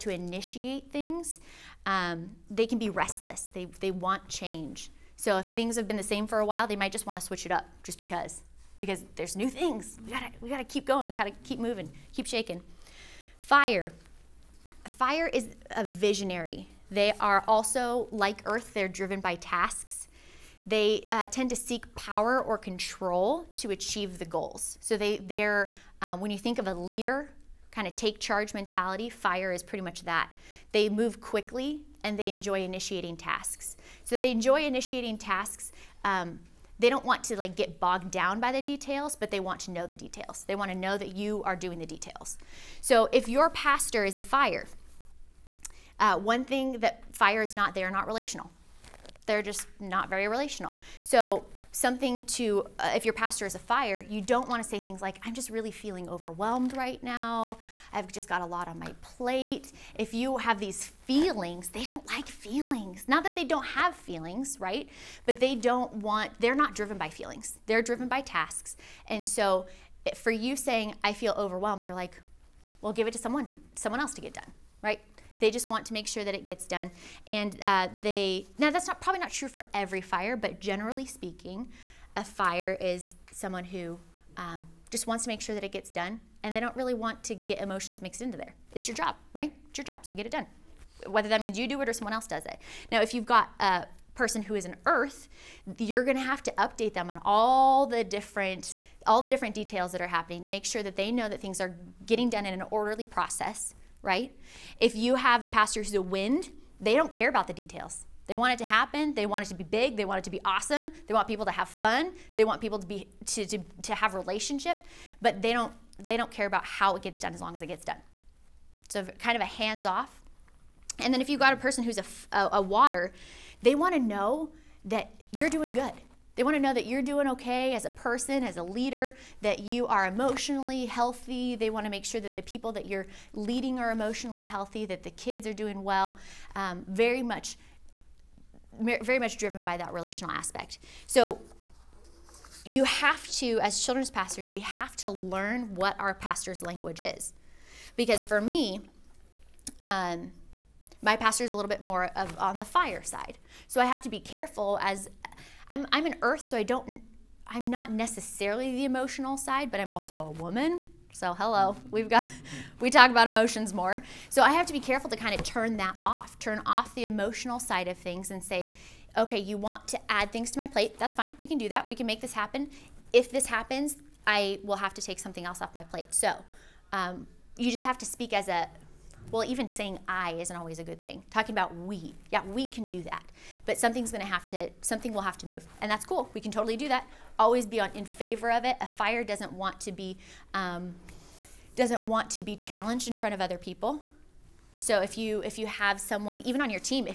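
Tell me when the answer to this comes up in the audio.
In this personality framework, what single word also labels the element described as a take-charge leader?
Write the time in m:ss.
0:15.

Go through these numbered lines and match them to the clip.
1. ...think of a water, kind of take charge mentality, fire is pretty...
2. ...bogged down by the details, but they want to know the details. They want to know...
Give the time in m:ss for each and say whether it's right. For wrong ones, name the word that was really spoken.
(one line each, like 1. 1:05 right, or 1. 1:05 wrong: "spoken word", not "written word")
1. 0:26 wrong: "leader", not "water"
2. 0:37 right.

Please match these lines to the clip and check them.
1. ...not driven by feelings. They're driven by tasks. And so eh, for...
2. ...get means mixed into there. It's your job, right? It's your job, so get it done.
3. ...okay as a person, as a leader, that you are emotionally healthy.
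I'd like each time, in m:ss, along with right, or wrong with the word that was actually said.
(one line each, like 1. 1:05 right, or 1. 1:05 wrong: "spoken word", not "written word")
1. 1:06 right
2. 1:27 wrong: "emotions", not "means"
3. 2:07 right.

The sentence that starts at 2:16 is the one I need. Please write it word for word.
Um, very much, very much driven by that relational aspect.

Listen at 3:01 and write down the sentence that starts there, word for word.
Talking about we, yeah, we can do that.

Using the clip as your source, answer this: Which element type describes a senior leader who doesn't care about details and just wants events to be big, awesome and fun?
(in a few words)
wind.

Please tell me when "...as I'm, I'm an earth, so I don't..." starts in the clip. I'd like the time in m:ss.
2:34.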